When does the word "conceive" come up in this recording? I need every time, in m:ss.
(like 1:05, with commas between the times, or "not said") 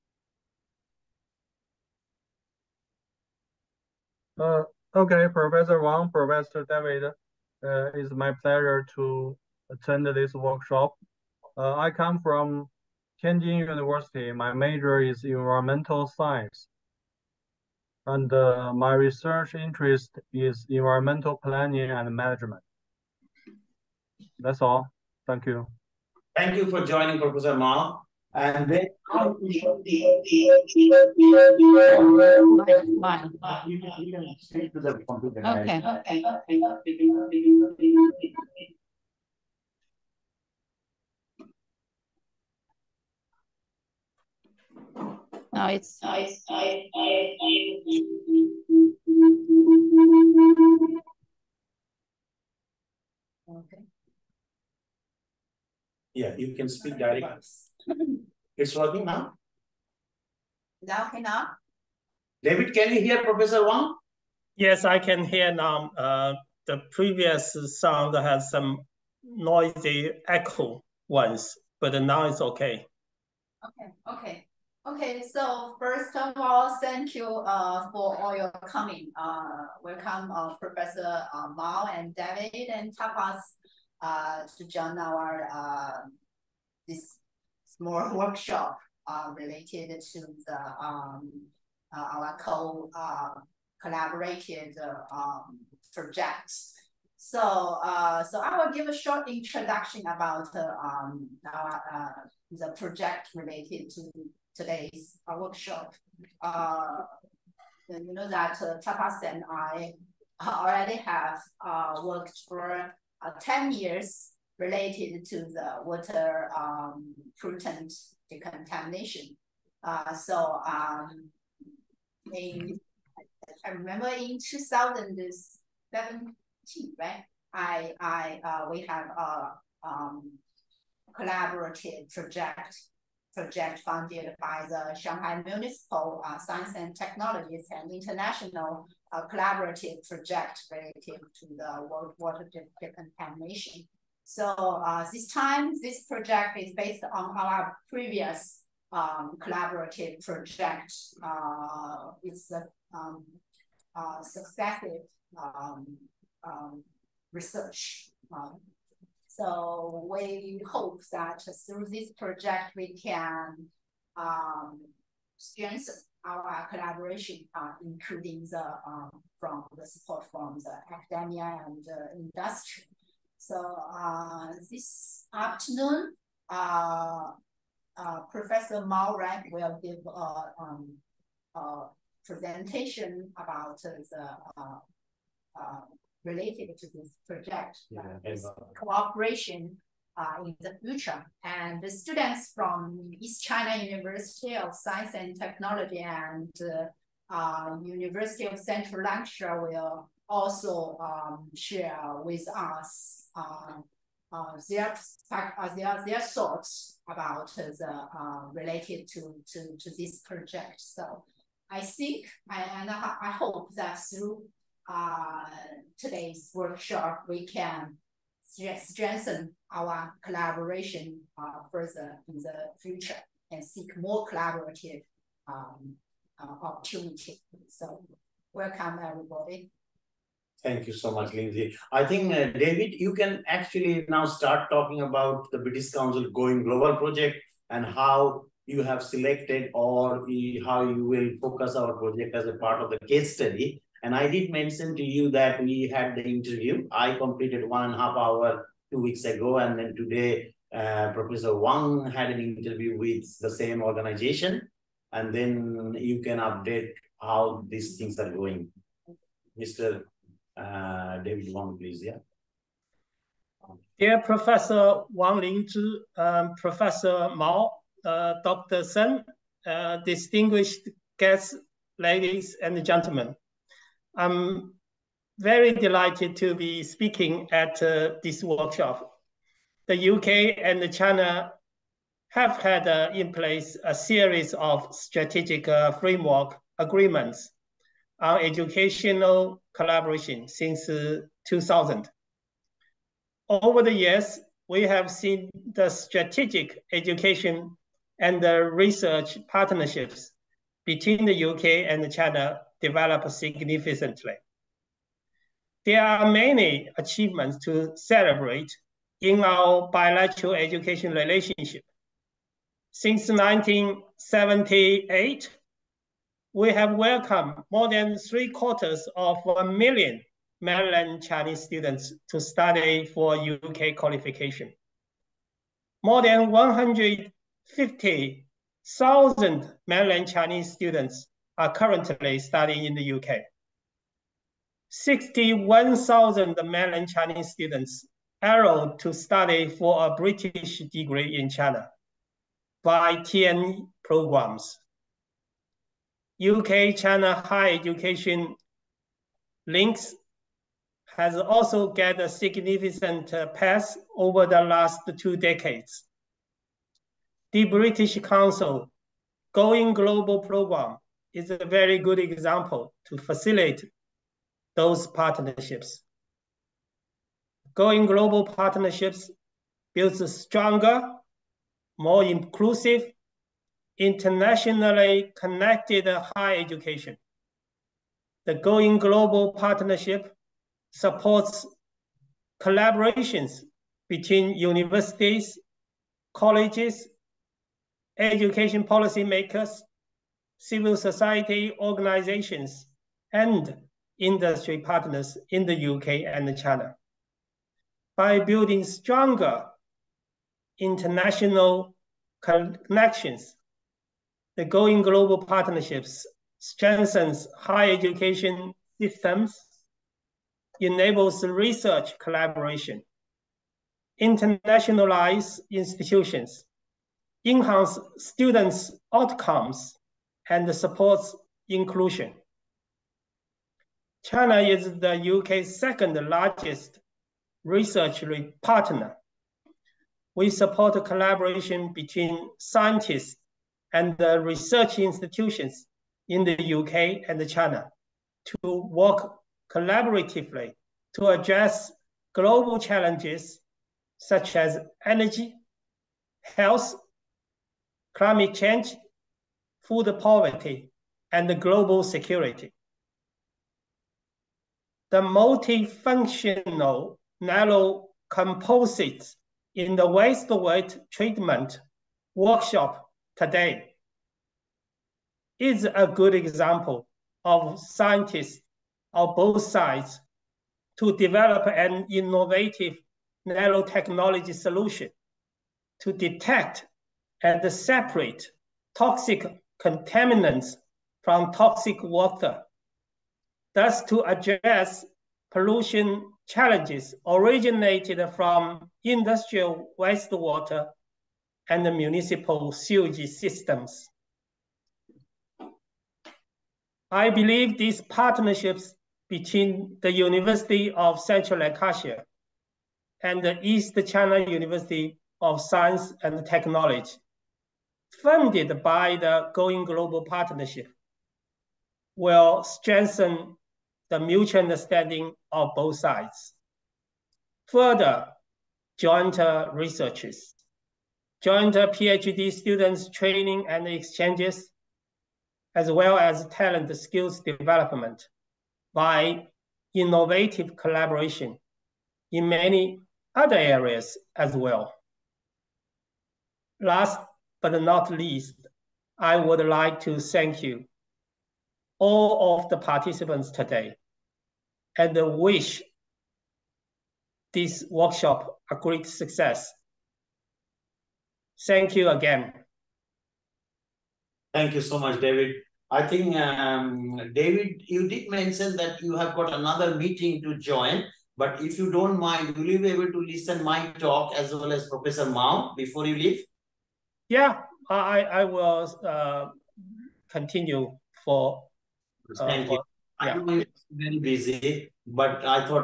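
not said.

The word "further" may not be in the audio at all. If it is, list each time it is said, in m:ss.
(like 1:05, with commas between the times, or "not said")
3:41, 8:37.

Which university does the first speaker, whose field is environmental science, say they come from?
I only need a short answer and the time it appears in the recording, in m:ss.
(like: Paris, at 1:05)
Tianjin University, at 0:13.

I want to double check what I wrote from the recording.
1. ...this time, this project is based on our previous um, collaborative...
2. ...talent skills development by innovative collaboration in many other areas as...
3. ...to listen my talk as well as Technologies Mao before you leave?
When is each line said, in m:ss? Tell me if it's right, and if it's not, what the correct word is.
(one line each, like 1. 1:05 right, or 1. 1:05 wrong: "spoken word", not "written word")
1. 2:25 right
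2. 8:46 right
3. 9:23 wrong: "Professor", not "Technologies".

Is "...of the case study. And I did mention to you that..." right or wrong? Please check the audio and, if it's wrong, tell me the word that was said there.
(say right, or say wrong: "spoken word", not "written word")
right.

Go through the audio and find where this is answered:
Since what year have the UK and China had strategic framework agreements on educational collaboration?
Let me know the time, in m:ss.
4:51.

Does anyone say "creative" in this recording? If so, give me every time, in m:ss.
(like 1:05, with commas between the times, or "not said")
not said.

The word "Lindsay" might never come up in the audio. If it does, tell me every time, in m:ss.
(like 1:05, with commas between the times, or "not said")
3:51.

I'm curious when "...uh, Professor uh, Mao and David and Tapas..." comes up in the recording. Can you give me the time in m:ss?
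1:20.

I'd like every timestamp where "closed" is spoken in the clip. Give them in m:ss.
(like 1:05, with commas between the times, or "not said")
not said.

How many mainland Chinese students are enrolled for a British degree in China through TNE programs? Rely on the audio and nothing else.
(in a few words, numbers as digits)
61,000.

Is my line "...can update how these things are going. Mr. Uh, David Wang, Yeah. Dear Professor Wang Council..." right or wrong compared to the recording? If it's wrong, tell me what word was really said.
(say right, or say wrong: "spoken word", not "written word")
wrong: "Lingzhi", not "Council".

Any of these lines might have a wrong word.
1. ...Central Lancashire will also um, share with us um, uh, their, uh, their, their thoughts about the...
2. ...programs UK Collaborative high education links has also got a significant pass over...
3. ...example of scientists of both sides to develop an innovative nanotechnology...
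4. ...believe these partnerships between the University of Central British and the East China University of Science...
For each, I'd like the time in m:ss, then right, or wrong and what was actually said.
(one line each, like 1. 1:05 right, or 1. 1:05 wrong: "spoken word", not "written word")
1. 3:18 right
2. 5:44 wrong: "China", not "Collaborative"
3. 7:46 right
4. 8:17 wrong: "Lancashire", not "British".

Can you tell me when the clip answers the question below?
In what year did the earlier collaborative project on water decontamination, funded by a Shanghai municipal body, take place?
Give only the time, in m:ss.
2:04.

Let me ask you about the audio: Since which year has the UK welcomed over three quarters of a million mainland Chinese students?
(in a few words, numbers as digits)
1978.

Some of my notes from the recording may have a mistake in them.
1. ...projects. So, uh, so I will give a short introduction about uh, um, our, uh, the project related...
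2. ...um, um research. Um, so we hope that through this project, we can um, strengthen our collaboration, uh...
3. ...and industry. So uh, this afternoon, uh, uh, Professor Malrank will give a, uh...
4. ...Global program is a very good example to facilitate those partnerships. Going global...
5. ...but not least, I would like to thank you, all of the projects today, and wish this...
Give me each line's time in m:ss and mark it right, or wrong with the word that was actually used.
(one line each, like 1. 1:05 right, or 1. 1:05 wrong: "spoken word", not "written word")
1. 1:35 right
2. 2:35 right
3. 2:51 right
4. 5:59 right
5. 8:57 wrong: "participants", not "projects".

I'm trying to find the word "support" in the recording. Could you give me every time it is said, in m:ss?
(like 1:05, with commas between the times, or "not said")
2:49, 6:20, 7:00, 7:10.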